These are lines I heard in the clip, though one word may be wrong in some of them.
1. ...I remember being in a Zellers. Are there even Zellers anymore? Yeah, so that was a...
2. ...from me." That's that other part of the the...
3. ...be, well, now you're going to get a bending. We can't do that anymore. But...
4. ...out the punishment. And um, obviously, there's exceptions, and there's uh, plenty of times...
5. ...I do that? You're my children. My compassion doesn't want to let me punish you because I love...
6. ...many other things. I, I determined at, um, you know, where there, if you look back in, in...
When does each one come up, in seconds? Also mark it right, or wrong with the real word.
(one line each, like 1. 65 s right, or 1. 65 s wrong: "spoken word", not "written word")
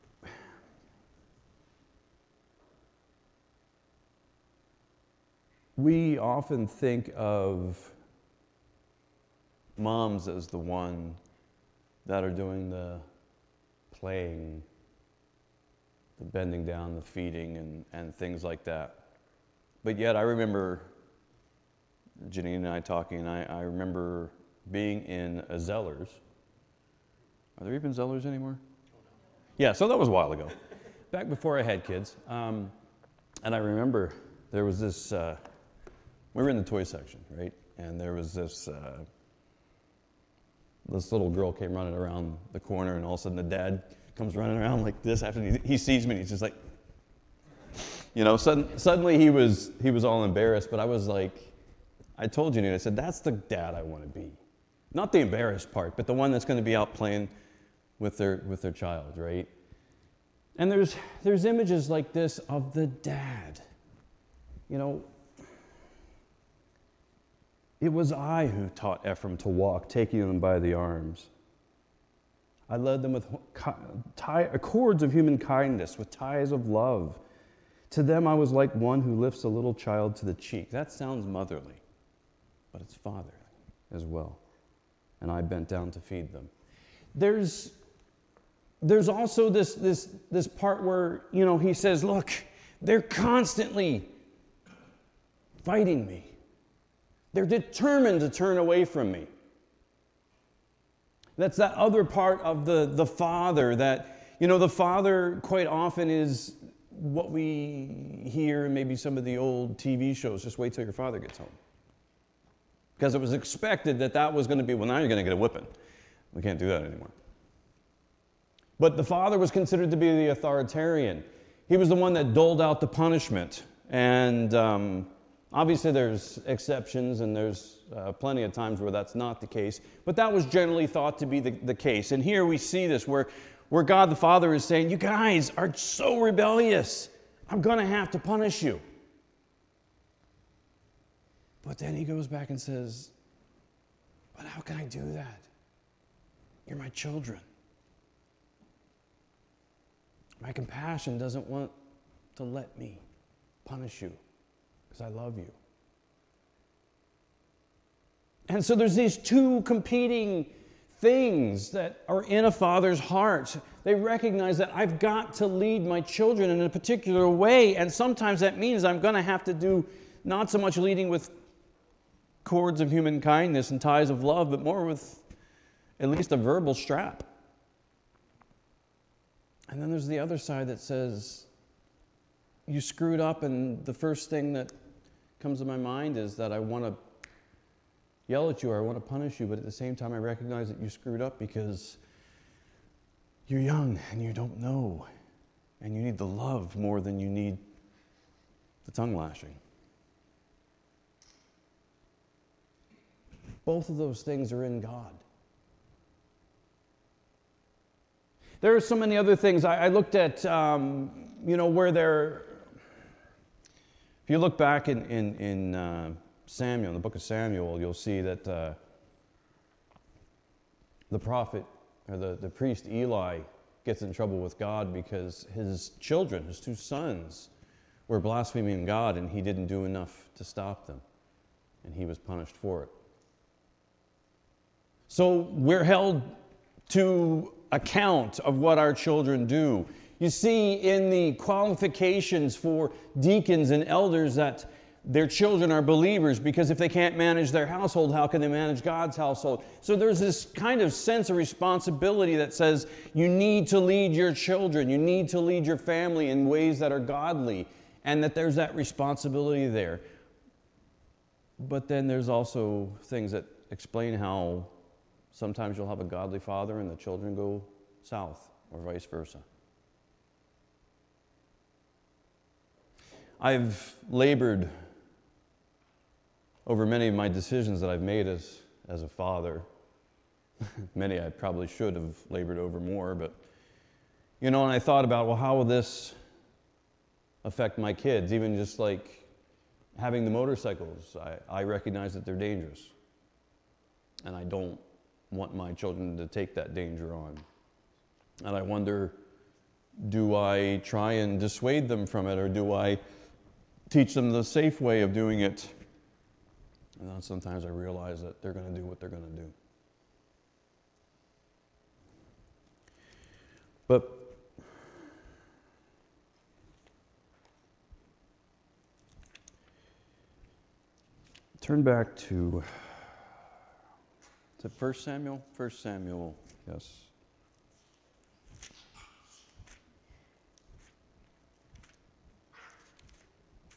1. 23 s right
2. 98 s right
3. 114 s wrong: "whipping", not "bending"
4. 122 s right
5. 144 s right
6. 208 s wrong: "looked", not "determined".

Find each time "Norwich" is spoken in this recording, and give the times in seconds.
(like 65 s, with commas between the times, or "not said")
not said.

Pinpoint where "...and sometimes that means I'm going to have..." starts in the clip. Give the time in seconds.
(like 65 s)
167 s.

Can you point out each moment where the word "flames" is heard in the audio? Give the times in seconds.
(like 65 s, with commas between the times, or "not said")
not said.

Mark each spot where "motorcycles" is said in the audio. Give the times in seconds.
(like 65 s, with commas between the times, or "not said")
290 s.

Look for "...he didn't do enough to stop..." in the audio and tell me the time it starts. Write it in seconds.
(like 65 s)
229 s.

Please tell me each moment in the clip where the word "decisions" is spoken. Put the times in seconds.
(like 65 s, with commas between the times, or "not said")
277 s.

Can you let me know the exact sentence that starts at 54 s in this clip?
Not the embarrassed part, but the one that's going to be out playing with their, with their child, right?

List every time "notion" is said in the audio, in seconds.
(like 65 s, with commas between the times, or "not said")
not said.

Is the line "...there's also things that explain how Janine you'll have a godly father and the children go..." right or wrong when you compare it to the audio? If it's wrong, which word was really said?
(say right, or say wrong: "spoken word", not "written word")
wrong: "Sometimes", not "Janine".